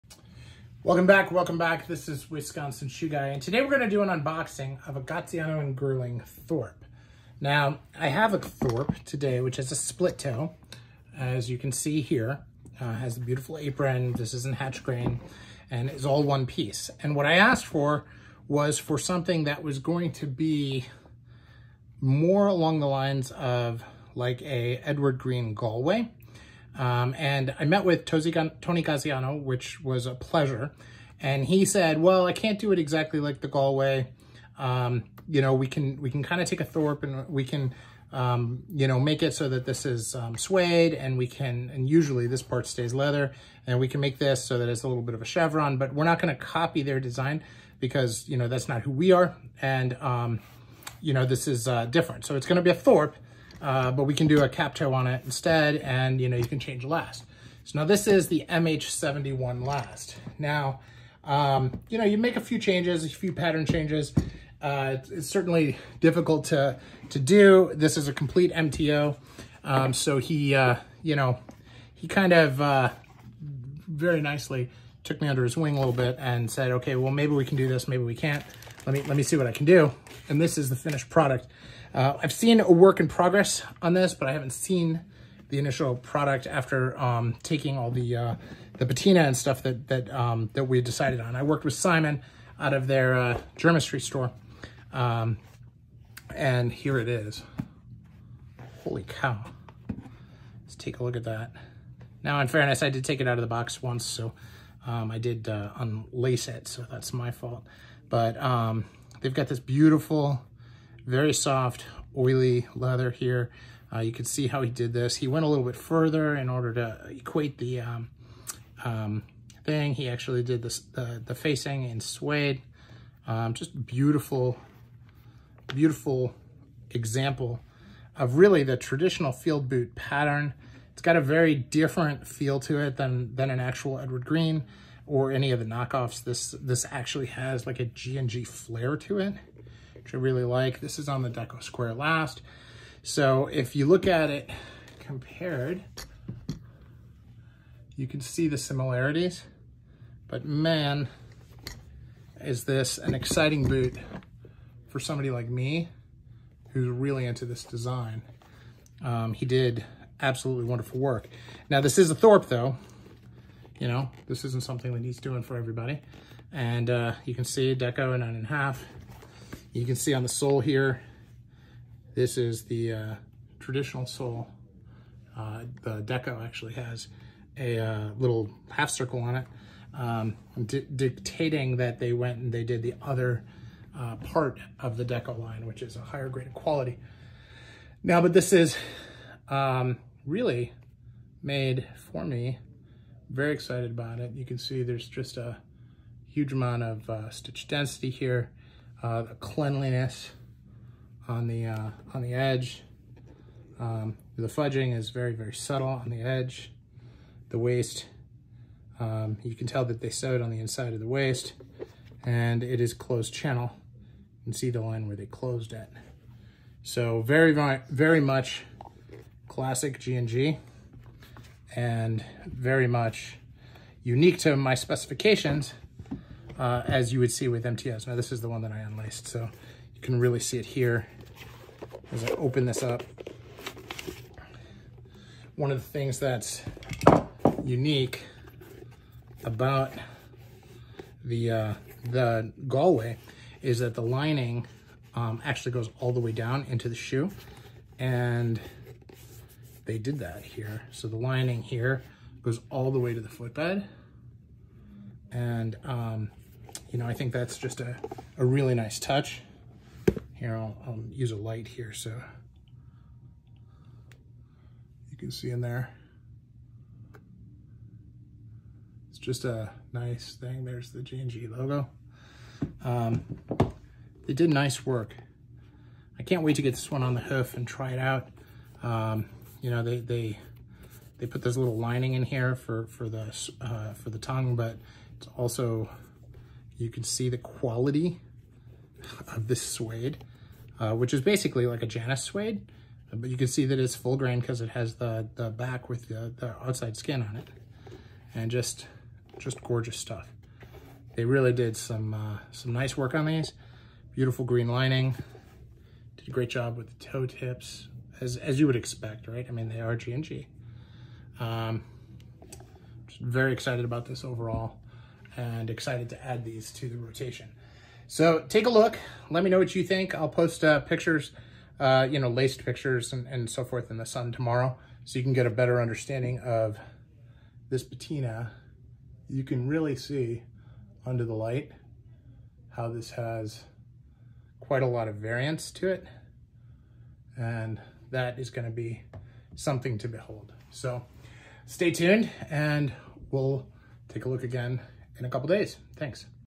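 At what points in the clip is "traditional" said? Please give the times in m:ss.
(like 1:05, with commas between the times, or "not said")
2:08, 2:53.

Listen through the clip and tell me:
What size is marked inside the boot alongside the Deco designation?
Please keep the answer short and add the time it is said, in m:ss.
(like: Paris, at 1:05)
9.5, at 2:48.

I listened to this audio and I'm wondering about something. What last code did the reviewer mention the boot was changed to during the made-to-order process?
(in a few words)
MH71.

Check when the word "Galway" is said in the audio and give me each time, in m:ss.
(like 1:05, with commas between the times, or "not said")
0:25, 0:33, 4:02.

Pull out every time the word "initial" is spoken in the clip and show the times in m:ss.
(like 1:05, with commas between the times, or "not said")
1:25.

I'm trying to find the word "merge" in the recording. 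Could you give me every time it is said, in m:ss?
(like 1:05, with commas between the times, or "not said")
not said.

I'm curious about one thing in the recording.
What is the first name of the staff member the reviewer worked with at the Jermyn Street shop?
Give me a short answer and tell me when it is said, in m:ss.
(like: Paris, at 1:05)
Simon, at 1:31.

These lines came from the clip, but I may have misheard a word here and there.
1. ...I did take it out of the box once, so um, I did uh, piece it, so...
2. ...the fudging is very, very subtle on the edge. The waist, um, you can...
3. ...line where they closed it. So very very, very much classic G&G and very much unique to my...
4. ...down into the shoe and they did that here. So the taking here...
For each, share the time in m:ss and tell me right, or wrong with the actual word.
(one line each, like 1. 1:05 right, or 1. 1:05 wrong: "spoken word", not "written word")
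1. 1:42 wrong: "unlace", not "piece"
2. 3:24 right
3. 3:34 right
4. 4:06 wrong: "lining", not "taking".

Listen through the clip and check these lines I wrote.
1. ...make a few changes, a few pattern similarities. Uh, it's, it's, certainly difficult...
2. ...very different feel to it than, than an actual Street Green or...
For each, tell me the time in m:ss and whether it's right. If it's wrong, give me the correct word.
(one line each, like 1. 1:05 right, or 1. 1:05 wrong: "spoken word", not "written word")
1. 1:02 wrong: "changes", not "similarities"
2. 2:11 wrong: "Edward", not "Street".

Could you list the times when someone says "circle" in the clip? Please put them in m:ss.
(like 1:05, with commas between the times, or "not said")
2:58.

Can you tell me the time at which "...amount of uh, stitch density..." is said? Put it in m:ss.
3:16.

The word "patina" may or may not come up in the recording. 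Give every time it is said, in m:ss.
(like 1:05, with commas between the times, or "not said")
1:28, 5:27.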